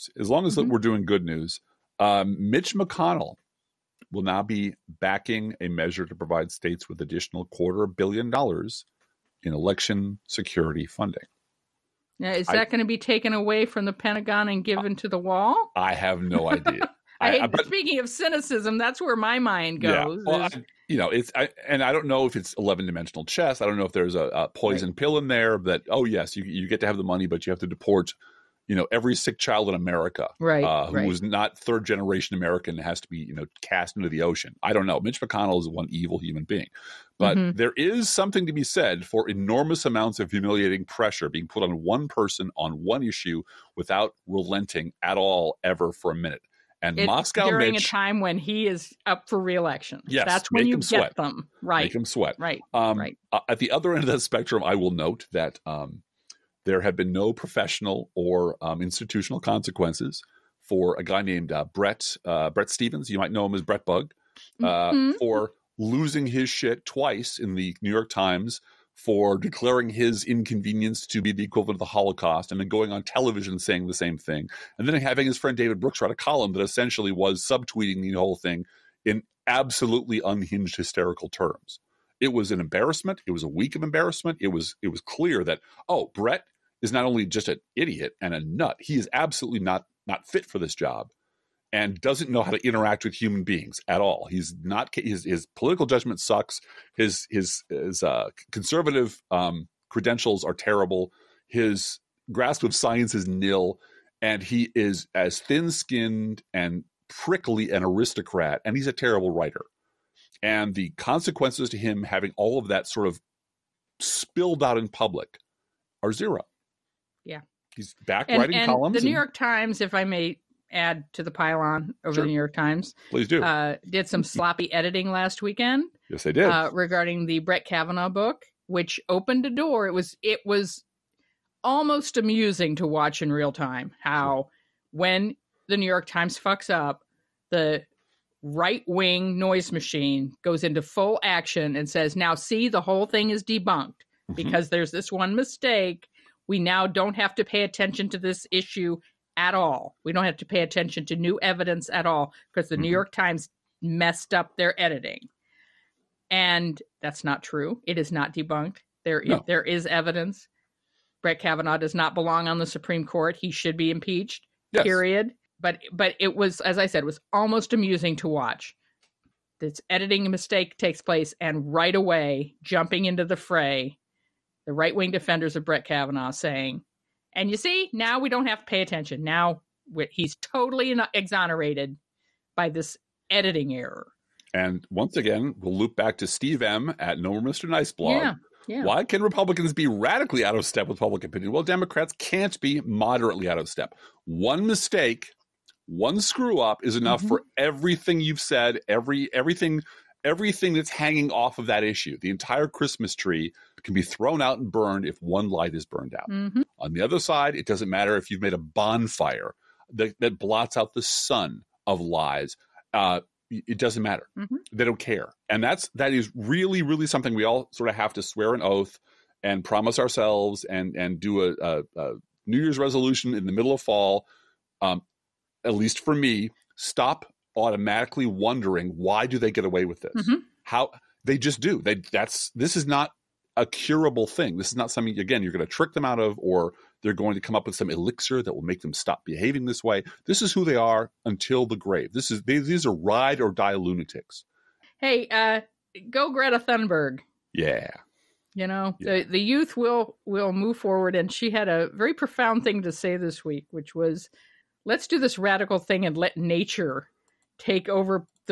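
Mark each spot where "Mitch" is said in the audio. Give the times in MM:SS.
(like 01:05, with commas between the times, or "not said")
00:02, 00:34, 00:47.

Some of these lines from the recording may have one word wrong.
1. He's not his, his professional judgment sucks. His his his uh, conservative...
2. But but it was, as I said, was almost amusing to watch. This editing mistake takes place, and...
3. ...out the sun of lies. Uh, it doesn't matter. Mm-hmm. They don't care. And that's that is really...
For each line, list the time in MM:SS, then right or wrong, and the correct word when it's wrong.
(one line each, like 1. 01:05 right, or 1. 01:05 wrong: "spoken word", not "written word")
1. 01:34 wrong: "political", not "professional"
2. 02:45 right
3. 03:30 right.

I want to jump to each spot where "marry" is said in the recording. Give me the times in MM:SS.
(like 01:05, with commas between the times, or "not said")
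not said.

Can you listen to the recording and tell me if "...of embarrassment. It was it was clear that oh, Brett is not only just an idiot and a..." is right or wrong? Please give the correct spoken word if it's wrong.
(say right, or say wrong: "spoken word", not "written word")
right.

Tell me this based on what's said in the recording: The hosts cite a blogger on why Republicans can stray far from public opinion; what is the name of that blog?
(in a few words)
No More Mr. Nice Blog.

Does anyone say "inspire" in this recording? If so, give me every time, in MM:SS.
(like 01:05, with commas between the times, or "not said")
not said.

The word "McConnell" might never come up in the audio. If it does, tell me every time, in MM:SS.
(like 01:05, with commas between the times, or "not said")
00:02, 00:35.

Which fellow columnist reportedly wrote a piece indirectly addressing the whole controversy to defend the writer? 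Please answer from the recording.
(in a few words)
David Brooks.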